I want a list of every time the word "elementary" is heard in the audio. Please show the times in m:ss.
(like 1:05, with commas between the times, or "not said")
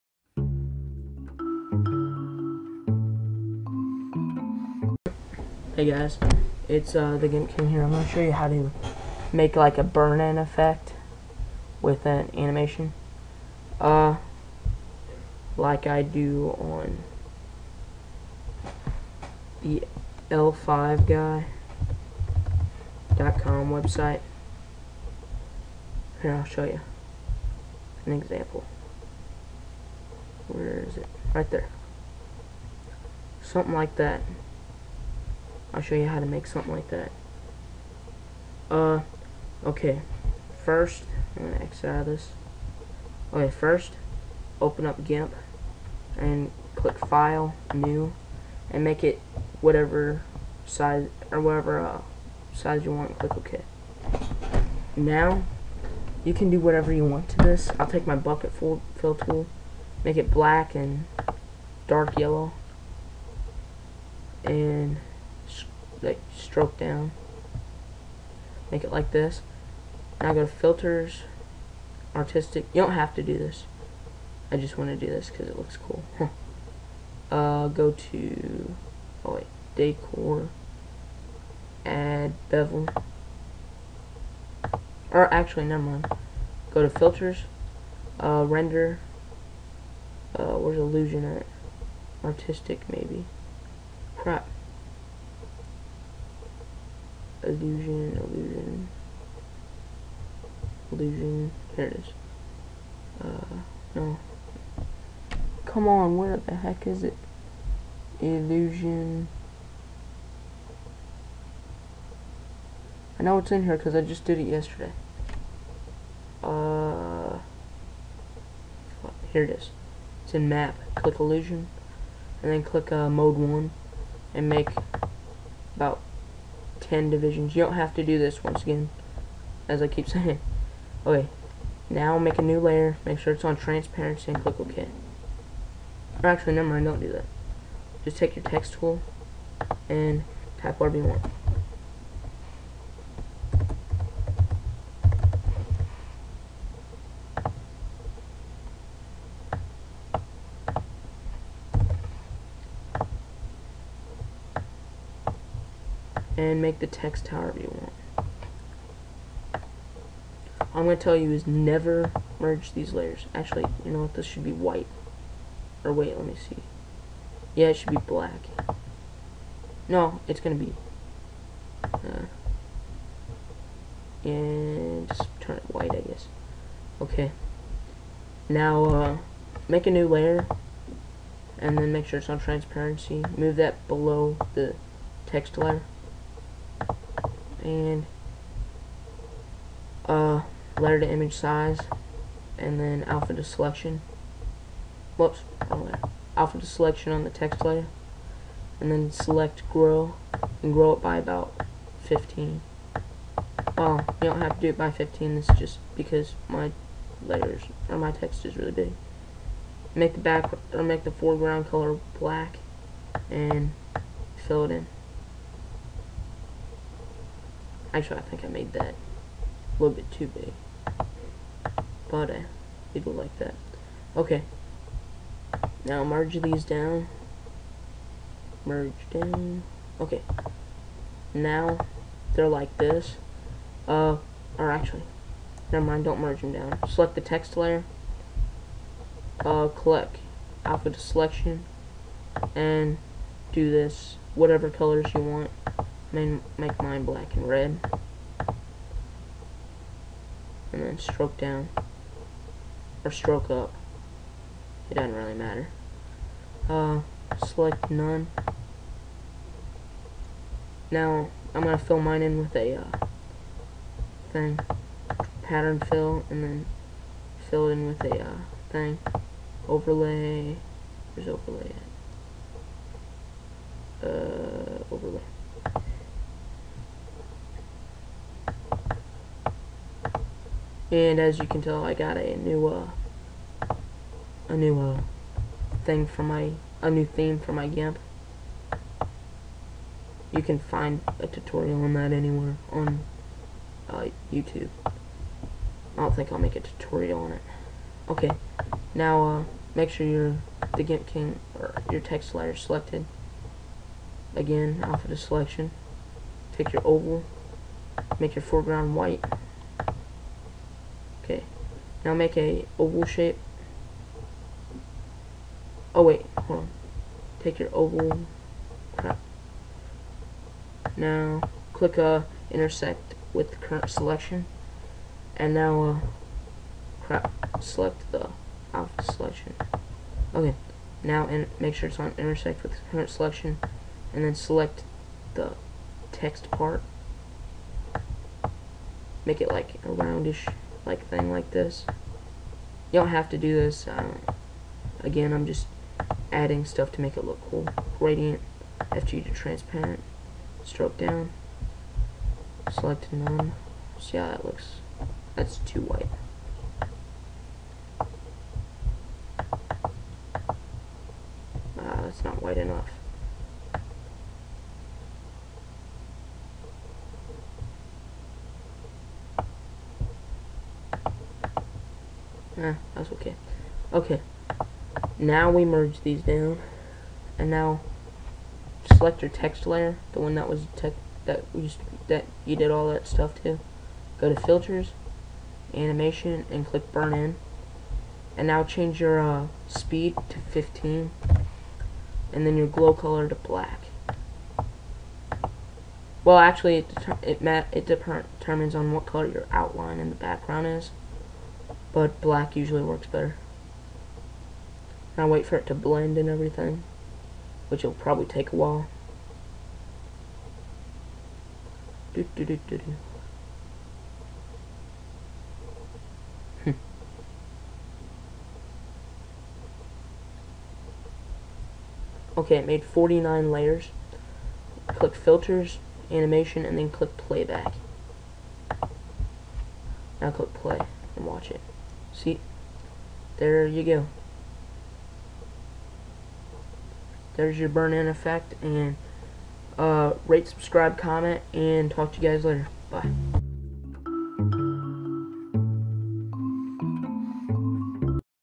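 not said.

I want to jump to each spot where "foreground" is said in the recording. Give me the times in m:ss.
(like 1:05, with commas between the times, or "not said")
3:31, 5:08.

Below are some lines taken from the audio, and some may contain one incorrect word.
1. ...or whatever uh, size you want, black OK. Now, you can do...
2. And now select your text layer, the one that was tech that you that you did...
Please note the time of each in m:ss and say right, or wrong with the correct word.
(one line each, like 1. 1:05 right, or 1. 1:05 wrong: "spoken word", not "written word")
1. 0:51 wrong: "click", not "black"
2. 6:17 right.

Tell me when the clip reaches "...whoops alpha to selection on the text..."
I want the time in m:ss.
3:15.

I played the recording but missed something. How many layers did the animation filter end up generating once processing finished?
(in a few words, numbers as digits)
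49.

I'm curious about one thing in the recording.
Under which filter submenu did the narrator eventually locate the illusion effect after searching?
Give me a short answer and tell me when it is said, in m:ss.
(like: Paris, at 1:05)
Map, at 2:00.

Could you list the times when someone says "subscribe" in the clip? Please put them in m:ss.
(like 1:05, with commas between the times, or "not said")
7:20.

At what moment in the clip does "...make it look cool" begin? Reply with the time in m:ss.
5:47.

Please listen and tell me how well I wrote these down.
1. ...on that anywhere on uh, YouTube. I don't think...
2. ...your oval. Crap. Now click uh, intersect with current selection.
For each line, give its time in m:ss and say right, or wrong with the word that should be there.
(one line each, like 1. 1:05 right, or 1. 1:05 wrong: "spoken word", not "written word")
1. 4:51 right
2. 5:17 right.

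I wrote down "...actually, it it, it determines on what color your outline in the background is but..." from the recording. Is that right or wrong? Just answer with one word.
right.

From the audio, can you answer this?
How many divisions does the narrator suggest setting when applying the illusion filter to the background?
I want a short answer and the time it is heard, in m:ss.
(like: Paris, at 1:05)
10, at 2:06.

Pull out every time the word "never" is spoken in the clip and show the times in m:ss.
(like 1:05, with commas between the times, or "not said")
1:25, 2:16, 2:41, 3:55.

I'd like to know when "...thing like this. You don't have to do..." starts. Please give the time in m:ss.
5:41.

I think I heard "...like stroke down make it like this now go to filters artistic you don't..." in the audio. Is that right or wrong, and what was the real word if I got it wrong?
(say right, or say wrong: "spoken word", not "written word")
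right.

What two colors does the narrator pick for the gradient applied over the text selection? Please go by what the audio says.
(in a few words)
Black and red.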